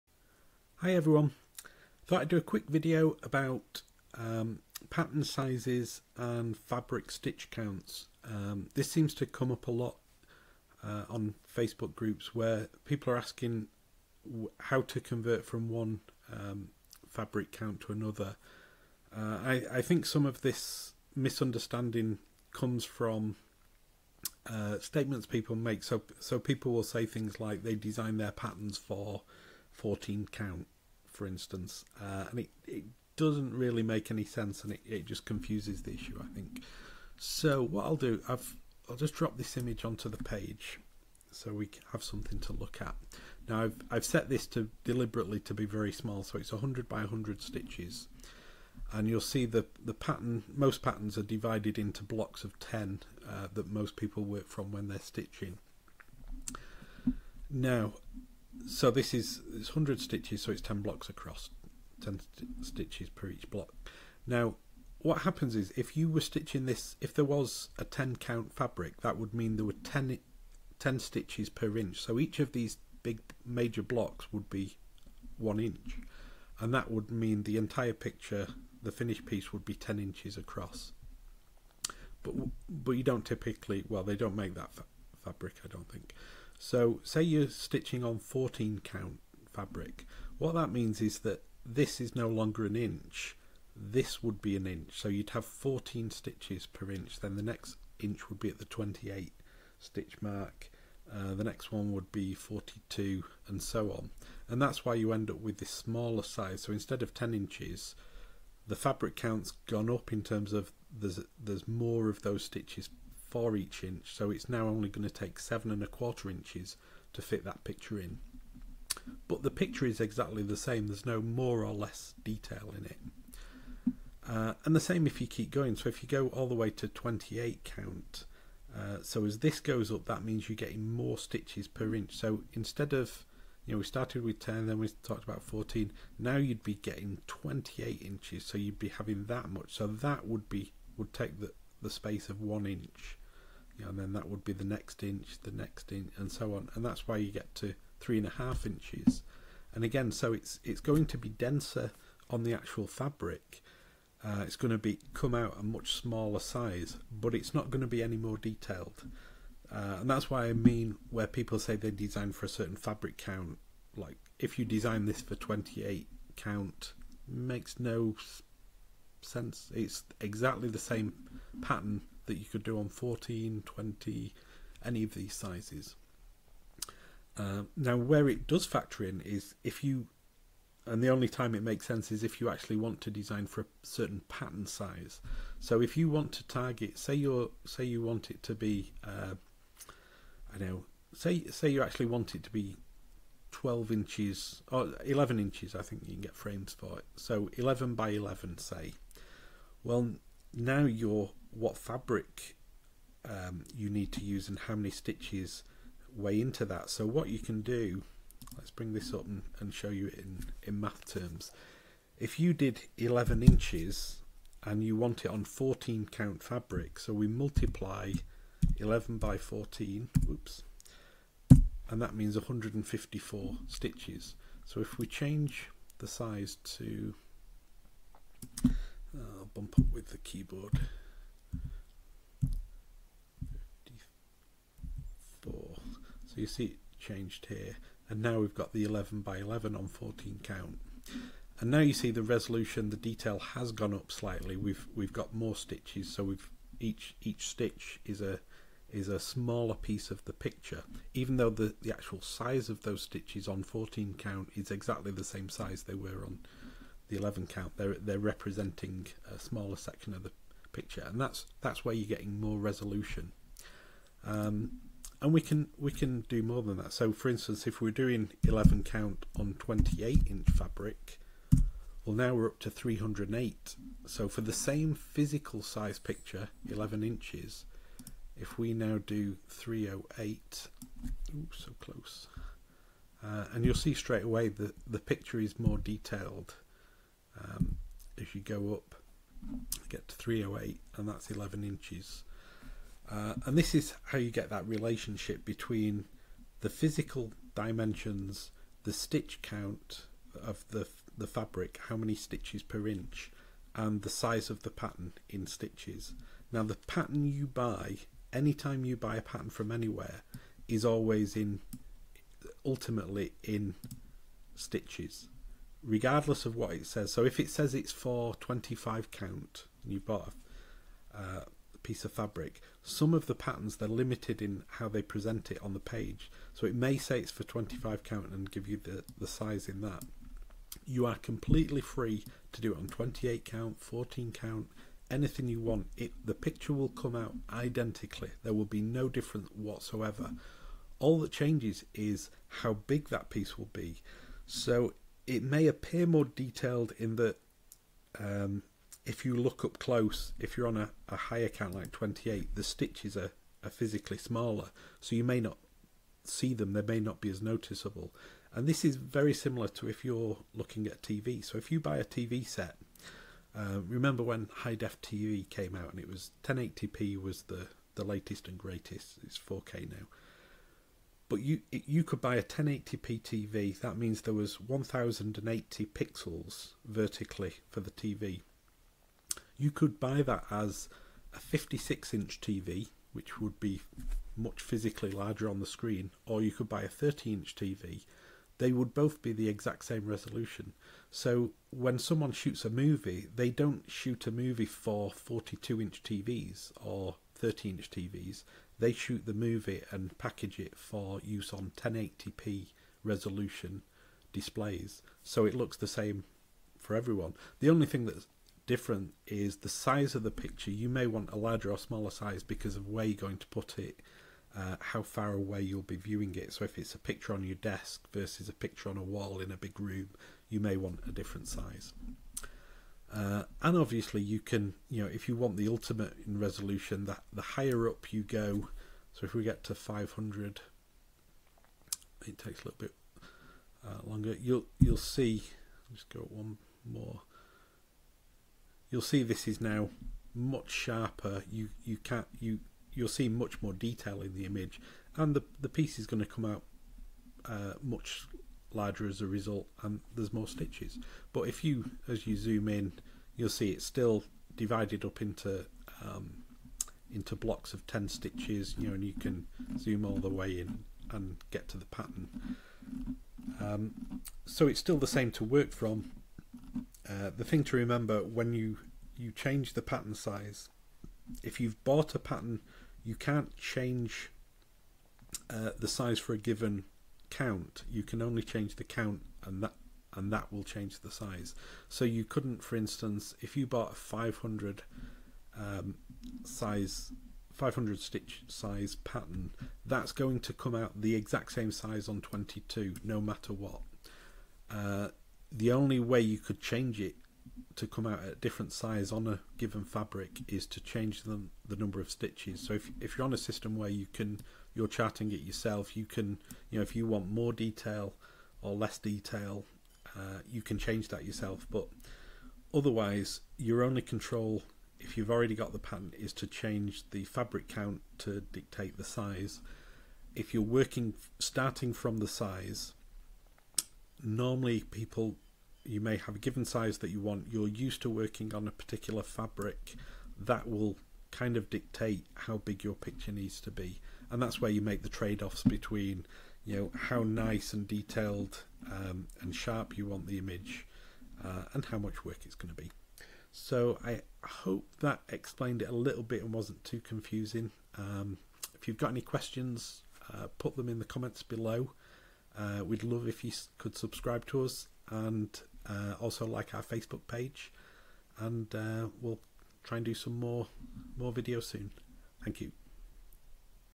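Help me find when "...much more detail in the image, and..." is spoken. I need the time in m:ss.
7:23.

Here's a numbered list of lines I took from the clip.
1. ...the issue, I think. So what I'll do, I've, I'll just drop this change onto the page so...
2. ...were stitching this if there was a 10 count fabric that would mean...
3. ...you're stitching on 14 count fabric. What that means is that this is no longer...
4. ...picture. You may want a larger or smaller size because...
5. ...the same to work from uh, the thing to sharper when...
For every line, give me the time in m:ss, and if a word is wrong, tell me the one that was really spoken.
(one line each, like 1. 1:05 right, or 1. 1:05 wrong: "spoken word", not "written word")
1. 0:35 wrong: "image", not "change"
2. 1:06 right
3. 1:27 right
4. 6:50 right
5. 7:44 wrong: "remember", not "sharper".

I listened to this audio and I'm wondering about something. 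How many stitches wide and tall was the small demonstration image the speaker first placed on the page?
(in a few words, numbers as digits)
100 by 100.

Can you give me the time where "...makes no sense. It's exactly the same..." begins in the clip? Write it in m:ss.
2:47.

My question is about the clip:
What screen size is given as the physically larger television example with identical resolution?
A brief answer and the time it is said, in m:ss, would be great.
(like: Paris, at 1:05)
56 inches, at 6:21.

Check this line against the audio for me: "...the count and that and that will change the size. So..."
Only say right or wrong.
right.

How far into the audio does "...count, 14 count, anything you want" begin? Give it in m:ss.
5:33.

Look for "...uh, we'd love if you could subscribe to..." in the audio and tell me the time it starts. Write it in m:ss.
9:12.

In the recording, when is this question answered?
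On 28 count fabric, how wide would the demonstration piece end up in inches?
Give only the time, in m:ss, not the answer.
2:27.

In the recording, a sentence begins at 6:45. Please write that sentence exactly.
So it looks the same for everyone.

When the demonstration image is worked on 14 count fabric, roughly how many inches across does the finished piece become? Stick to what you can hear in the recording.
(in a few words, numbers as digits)
7.25 inches.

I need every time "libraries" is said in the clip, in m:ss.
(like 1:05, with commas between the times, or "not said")
not said.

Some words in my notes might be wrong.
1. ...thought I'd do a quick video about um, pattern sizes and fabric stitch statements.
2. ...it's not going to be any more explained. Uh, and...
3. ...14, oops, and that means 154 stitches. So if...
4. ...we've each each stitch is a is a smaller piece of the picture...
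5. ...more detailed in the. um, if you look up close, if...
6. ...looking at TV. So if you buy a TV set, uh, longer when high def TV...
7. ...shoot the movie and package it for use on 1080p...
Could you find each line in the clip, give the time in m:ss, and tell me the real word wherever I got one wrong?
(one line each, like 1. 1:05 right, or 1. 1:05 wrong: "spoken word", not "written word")
1. 0:02 wrong: "counts", not "statements"
2. 2:37 wrong: "detailed", not "explained"
3. 3:39 right
4. 4:06 right
5. 5:46 right
6. 6:00 wrong: "remember", not "longer"
7. 6:38 right.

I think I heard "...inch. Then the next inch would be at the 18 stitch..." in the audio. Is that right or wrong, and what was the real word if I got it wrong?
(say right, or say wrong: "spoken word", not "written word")
wrong: "28", not "18".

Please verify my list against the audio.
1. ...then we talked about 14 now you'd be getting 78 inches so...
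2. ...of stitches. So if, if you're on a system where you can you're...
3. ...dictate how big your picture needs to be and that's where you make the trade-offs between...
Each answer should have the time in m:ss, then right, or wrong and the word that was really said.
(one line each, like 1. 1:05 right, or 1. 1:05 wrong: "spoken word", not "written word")
1. 2:14 wrong: "28", not "78"
2. 8:21 right
3. 8:51 right.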